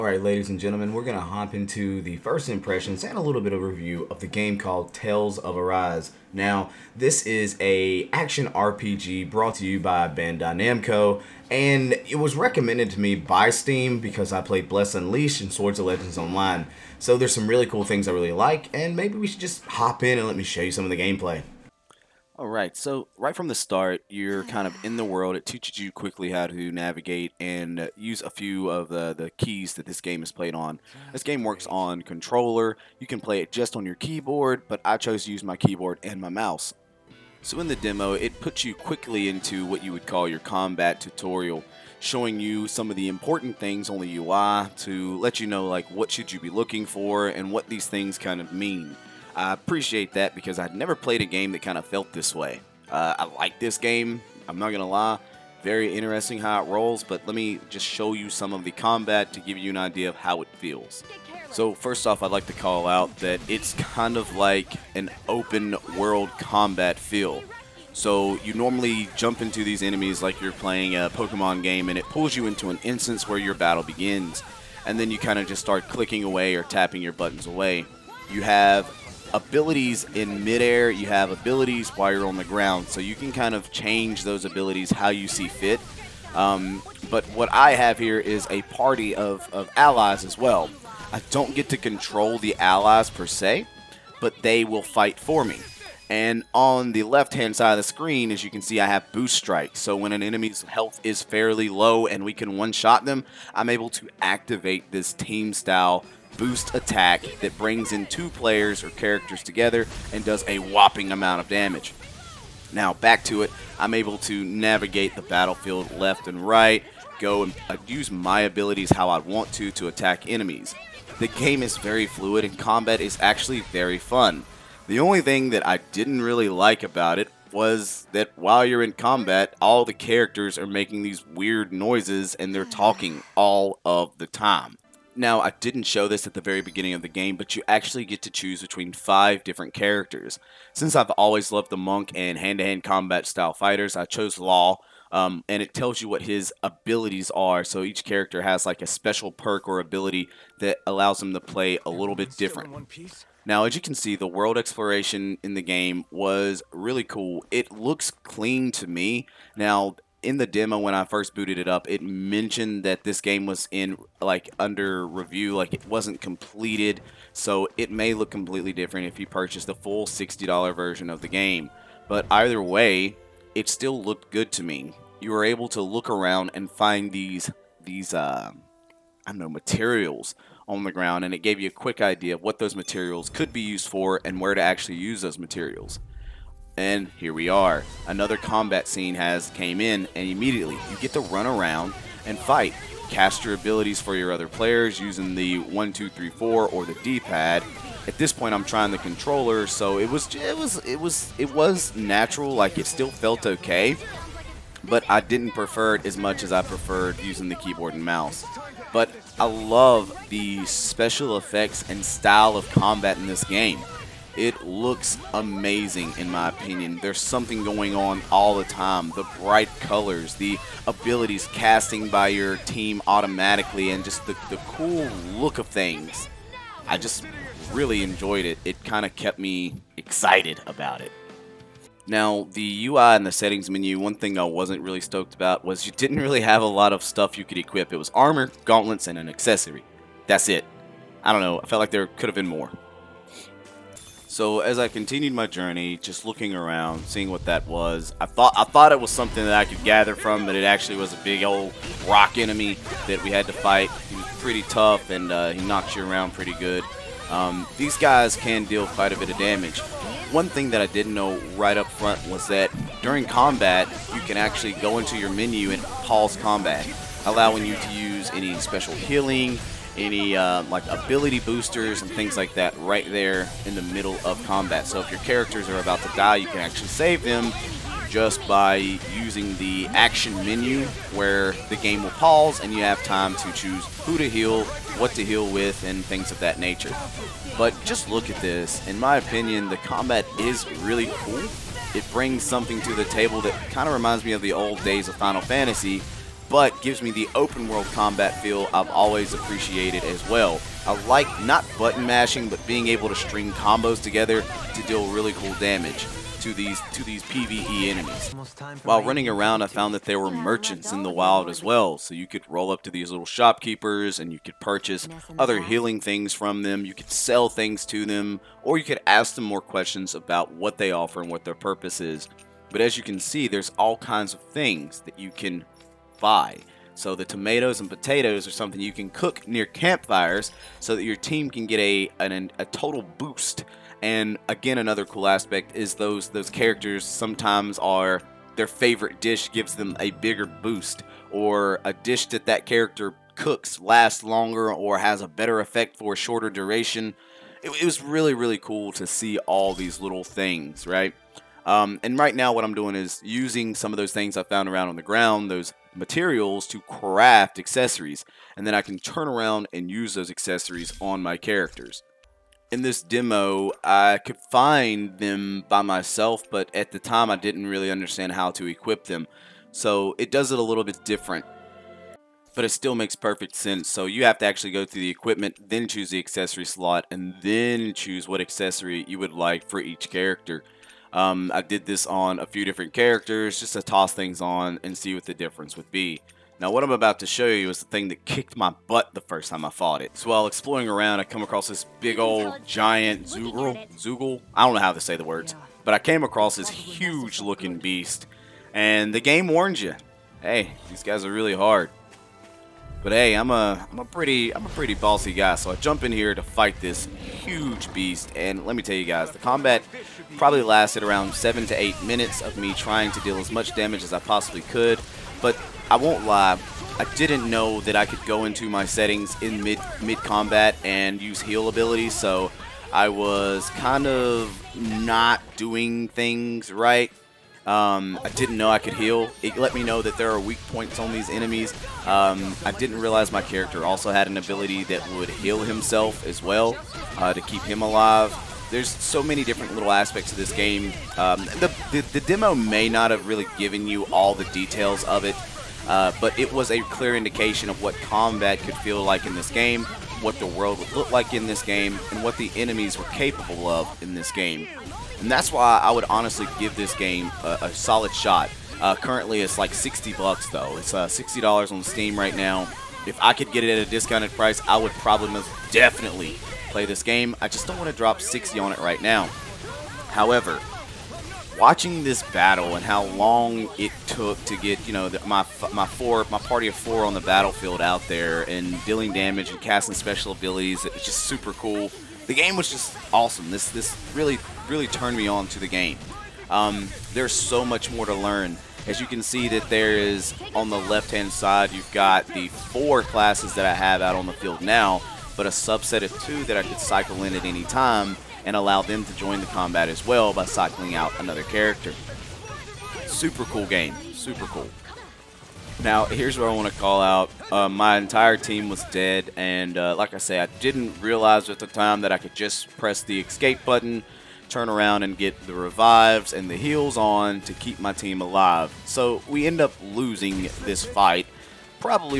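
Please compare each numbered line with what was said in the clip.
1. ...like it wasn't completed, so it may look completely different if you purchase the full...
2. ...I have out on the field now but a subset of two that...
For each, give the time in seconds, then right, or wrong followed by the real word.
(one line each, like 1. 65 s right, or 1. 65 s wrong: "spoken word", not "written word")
1. 165 s right
2. 493 s right.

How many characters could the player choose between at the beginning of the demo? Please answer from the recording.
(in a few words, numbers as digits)
5.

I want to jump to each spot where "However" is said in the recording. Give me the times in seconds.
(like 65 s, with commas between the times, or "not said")
470 s.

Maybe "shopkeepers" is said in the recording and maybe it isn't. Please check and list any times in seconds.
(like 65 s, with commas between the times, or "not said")
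313 s.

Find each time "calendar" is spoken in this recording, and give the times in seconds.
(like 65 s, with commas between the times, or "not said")
not said.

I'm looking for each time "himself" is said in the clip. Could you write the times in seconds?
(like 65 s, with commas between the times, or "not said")
435 s.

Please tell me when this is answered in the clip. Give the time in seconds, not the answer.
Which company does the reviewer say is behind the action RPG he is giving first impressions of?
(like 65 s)
10 s.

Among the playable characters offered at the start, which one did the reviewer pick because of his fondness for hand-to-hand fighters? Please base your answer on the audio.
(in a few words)
Law.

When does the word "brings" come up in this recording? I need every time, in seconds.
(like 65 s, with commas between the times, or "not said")
107 s, 292 s.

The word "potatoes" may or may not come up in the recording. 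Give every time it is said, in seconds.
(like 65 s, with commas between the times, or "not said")
327 s.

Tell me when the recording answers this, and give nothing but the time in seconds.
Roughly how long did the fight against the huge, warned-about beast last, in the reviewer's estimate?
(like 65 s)
411 s.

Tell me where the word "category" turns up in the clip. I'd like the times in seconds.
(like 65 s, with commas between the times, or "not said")
not said.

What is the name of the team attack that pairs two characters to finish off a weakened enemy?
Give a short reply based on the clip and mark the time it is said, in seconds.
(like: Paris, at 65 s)
Boost Strike, at 99 s.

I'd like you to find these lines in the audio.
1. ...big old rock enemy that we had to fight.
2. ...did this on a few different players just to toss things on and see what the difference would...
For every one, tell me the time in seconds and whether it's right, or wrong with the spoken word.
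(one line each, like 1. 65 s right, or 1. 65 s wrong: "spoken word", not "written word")
1. 251 s right
2. 381 s wrong: "characters", not "players".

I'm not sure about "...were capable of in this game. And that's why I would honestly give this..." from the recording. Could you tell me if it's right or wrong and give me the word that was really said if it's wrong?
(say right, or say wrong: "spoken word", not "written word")
right.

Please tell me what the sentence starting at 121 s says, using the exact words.
The game is very fluid and combat is actually very fun.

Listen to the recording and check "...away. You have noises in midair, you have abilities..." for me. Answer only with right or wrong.
wrong.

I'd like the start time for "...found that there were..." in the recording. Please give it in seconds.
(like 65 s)
309 s.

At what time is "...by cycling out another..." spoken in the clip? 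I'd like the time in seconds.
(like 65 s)
500 s.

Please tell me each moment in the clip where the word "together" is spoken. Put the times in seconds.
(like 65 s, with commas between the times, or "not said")
109 s, 304 s.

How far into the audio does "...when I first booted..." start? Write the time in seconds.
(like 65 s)
160 s.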